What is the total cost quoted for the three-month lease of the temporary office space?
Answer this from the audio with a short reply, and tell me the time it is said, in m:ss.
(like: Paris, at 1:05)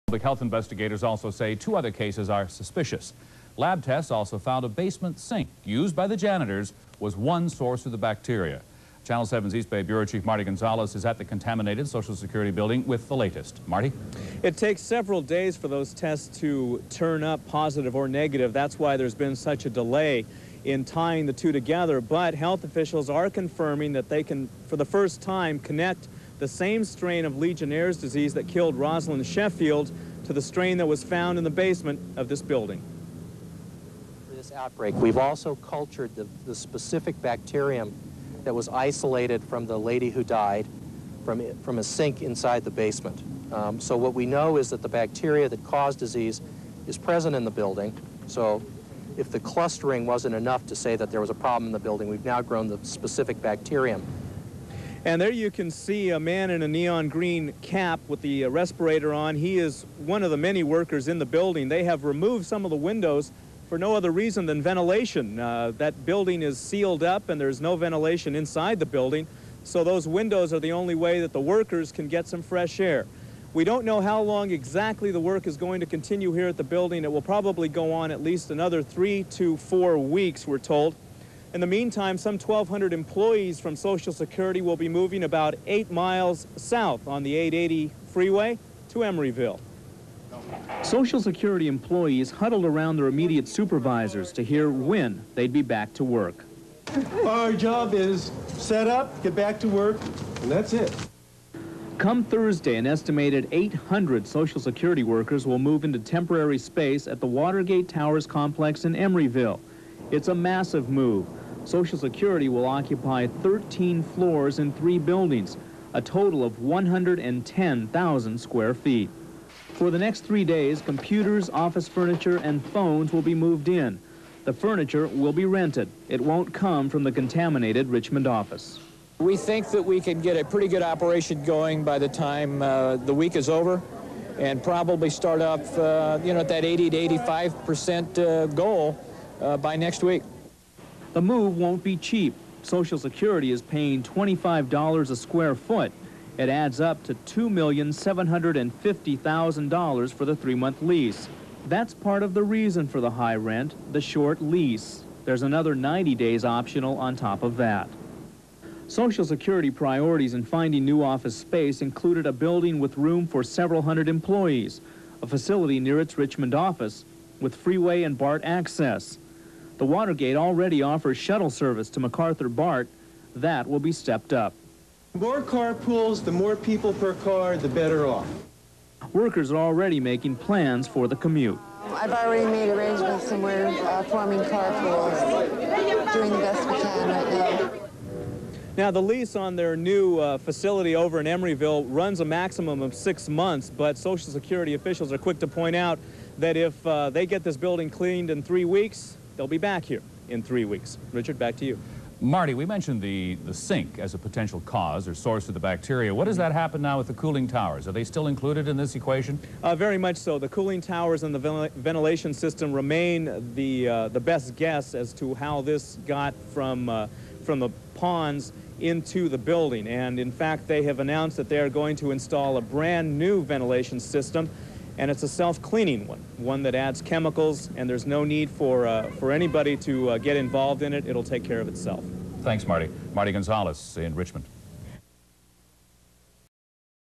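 $2,750,000, at 2:27.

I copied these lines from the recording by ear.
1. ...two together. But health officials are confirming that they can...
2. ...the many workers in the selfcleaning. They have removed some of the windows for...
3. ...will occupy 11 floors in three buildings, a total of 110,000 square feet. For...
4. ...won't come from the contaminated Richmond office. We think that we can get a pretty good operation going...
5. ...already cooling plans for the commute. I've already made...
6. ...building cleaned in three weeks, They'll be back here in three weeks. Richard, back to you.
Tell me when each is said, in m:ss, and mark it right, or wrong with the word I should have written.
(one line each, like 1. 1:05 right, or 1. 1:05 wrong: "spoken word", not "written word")
1. 0:21 right
2. 1:00 wrong: "building", not "selfcleaning"
3. 1:52 wrong: "13", not "11"
4. 2:06 right
5. 2:59 wrong: "making", not "cooling"
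6. 3:17 right.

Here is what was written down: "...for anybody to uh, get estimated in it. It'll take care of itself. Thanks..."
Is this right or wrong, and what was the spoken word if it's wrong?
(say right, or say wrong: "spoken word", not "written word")
wrong: "involved", not "estimated".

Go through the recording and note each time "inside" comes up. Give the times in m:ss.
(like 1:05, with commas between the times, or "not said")
0:42, 1:08.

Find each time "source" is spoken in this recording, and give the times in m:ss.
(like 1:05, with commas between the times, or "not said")
0:07, 3:25.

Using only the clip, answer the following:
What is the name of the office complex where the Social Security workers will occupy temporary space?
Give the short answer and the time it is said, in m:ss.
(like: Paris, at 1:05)
Watergate Towers, at 1:47.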